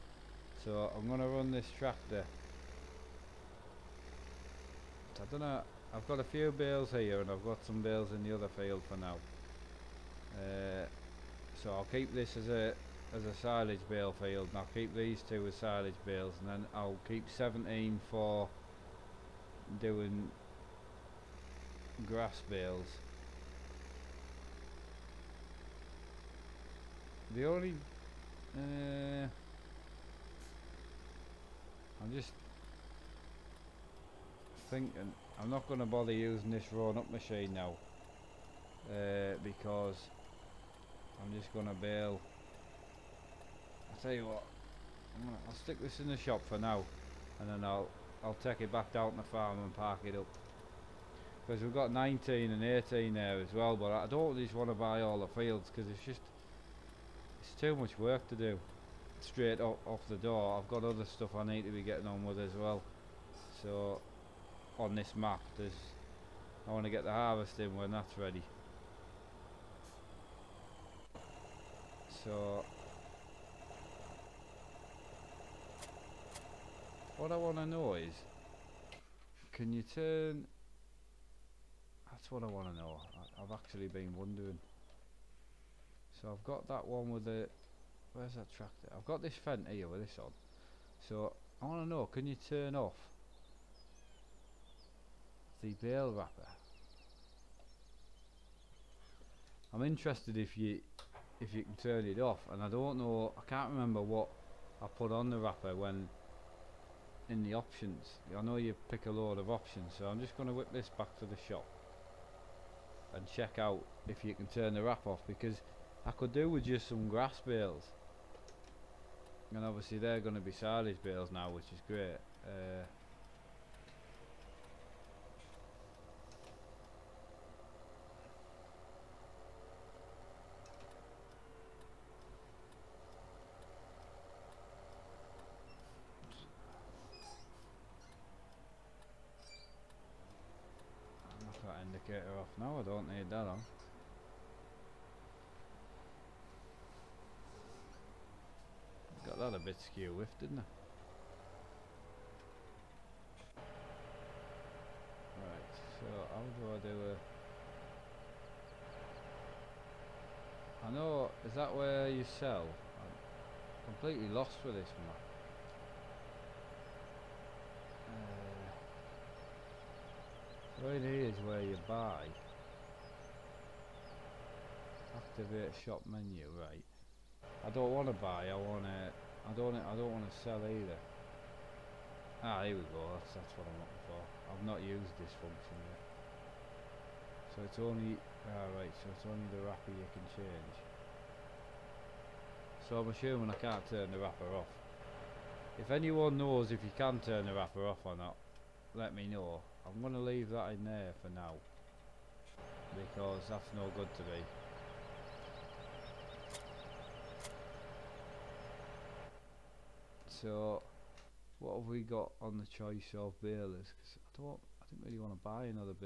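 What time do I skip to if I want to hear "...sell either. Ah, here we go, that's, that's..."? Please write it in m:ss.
3:00.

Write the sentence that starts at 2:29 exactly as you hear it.
Got that a bit skew with, didn't I?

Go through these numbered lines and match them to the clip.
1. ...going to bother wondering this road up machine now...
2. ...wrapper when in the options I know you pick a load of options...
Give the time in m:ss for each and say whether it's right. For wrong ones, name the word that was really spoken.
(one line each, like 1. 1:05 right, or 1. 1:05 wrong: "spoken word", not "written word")
1. 0:35 wrong: "using", not "wondering"
2. 1:45 right.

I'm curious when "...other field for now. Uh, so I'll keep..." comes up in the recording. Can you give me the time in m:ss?
0:08.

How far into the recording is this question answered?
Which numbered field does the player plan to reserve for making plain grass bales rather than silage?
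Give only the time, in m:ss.
0:17.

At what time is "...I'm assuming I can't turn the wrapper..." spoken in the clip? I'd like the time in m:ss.
3:13.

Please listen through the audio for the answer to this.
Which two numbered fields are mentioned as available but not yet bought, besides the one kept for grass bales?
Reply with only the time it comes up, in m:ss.
0:51.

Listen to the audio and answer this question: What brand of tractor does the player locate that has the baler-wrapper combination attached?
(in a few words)
Fendt.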